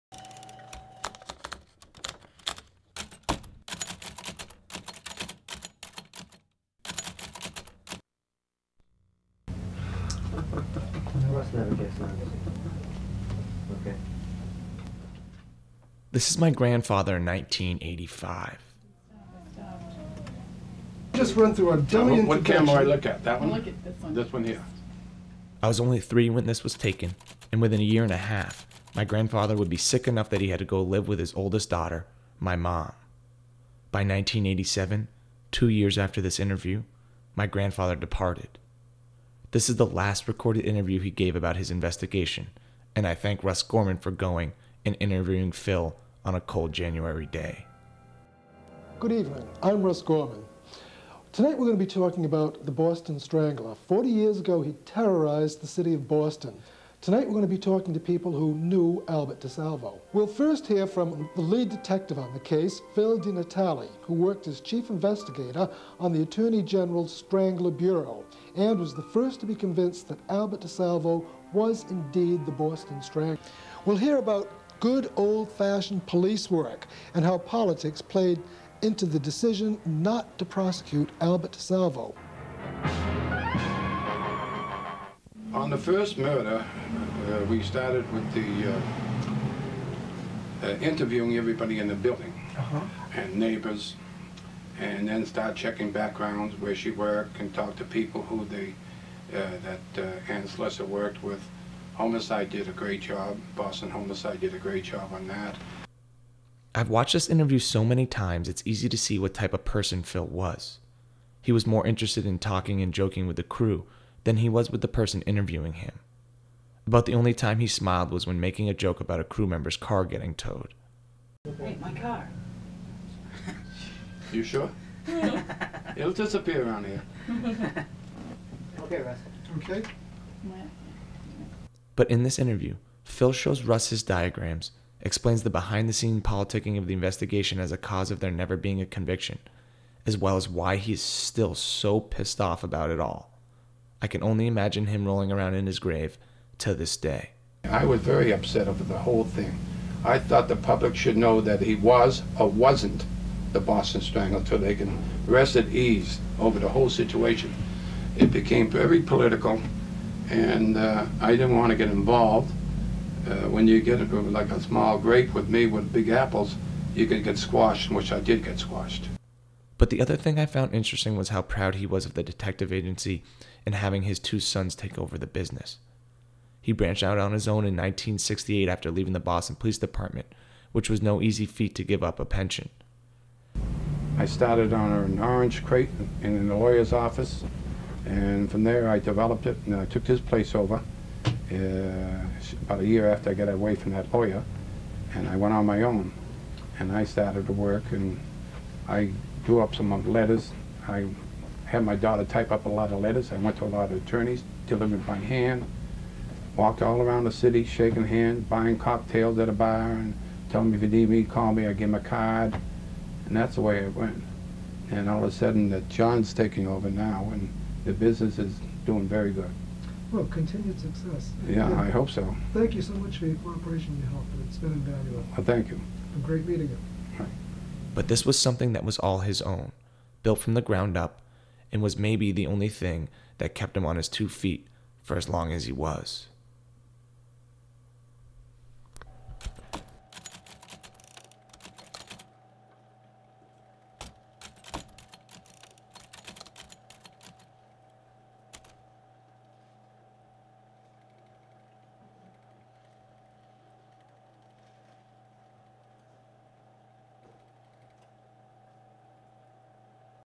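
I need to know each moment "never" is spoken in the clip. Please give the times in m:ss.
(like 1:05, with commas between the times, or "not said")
0:10, 2:18.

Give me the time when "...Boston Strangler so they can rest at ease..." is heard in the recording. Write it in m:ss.
2:33.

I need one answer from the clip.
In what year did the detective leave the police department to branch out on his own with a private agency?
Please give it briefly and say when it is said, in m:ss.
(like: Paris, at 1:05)
1968, at 2:57.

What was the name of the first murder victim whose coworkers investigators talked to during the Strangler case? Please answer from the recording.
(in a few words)
Ann Slesers.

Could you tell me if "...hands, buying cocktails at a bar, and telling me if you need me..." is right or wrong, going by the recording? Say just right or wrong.
right.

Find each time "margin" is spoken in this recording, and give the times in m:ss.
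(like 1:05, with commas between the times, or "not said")
not said.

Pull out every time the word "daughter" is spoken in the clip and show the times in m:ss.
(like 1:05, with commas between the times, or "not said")
0:31, 3:21.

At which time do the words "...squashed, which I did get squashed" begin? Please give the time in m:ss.
2:47.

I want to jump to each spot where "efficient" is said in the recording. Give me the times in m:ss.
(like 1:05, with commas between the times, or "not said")
not said.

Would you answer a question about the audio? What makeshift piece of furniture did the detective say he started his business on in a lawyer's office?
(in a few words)
an orange crate.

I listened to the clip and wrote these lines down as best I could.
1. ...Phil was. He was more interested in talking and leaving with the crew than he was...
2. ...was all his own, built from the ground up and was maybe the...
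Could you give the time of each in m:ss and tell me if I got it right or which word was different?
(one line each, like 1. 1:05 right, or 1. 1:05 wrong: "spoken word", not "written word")
1. 1:50 wrong: "joking", not "leaving"
2. 3:48 right.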